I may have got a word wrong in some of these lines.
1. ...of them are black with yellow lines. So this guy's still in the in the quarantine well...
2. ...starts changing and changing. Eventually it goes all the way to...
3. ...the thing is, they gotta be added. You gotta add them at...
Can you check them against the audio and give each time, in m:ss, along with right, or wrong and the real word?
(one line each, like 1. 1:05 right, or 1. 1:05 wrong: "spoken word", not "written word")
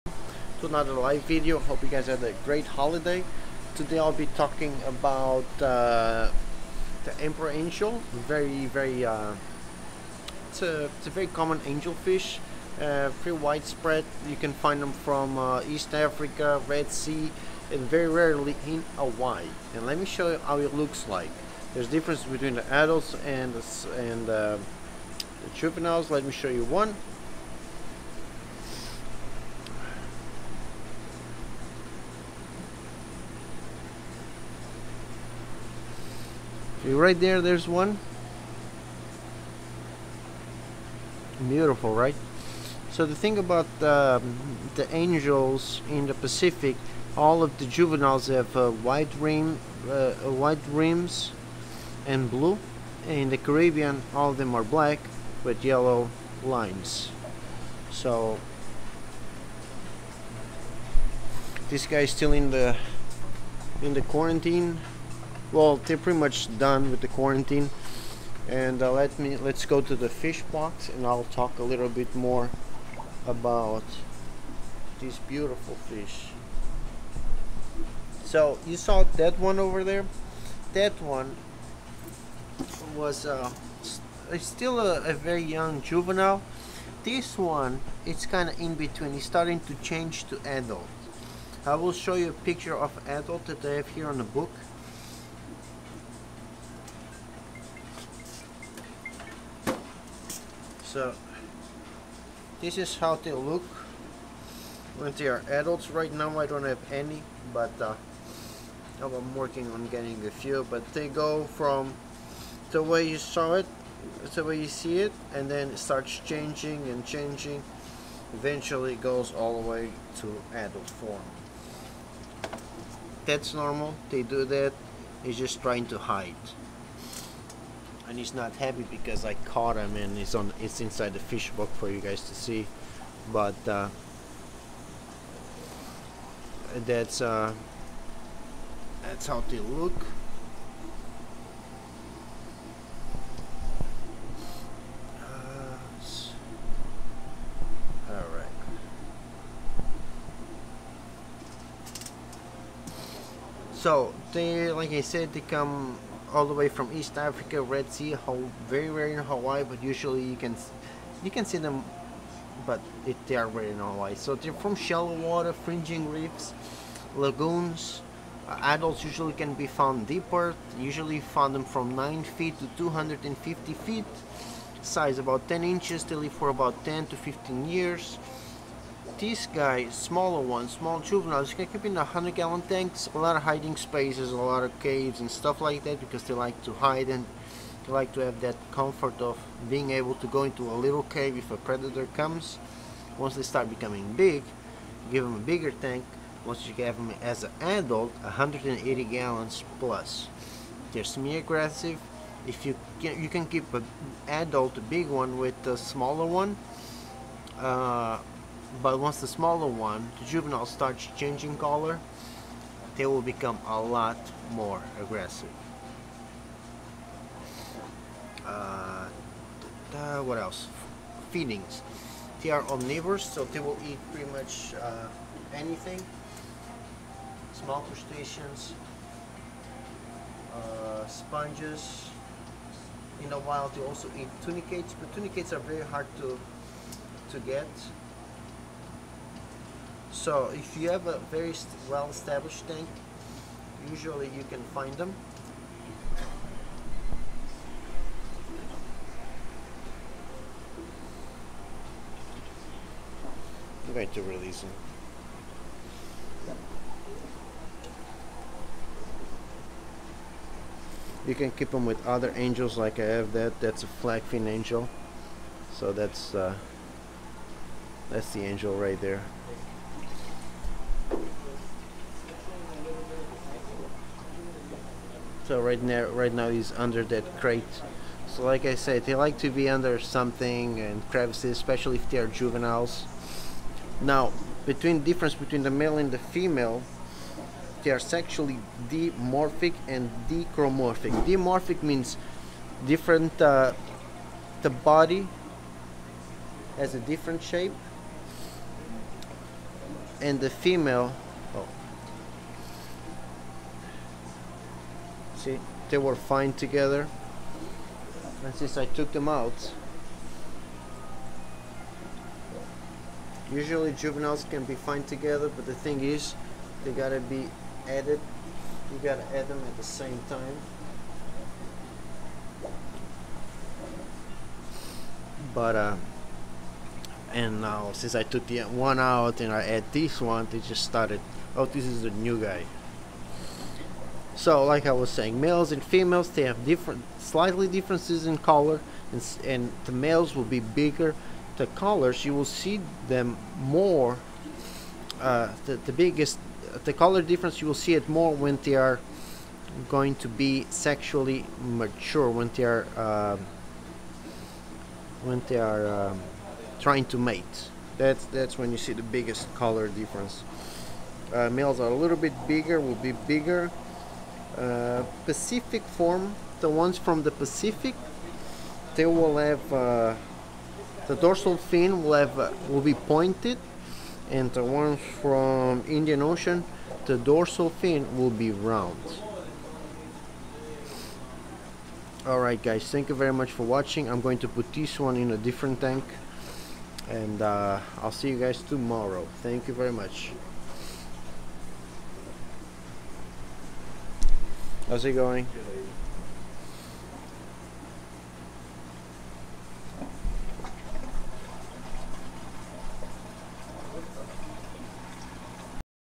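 1. 0:54 right
2. 1:55 right
3. 5:15 right.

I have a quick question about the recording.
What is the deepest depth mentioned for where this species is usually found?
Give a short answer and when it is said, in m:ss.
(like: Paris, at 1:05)
250 feet, at 2:52.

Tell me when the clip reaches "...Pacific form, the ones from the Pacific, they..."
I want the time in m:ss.
6:05.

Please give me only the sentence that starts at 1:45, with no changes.
Right now I don't have any, but uh, I'm working on getting a few.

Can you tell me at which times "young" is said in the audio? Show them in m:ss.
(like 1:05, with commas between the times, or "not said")
1:25.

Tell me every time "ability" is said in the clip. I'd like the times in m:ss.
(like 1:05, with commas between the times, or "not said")
not said.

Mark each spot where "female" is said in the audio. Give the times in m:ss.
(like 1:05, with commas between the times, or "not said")
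4:46, 5:00, 5:35.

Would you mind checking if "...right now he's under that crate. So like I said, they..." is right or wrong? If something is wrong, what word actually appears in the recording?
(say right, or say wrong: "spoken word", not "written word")
right.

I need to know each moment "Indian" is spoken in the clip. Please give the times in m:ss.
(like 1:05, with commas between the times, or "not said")
6:15.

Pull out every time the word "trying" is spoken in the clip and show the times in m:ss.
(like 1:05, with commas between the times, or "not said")
2:05, 5:56.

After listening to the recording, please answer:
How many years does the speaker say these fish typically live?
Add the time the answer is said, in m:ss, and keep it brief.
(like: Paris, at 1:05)
10 to 15 years, at 2:56.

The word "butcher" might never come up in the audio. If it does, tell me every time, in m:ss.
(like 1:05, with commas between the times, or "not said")
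not said.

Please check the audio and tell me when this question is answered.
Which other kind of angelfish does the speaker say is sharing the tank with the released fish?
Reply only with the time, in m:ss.
4:24.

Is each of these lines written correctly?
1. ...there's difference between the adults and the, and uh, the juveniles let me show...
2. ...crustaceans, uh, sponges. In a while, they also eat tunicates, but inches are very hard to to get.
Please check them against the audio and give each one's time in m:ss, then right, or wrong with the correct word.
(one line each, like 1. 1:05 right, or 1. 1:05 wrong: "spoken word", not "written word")
1. 0:21 right
2. 3:47 wrong: "tunicates", not "inches".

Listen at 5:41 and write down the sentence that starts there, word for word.
The colors you will see them more.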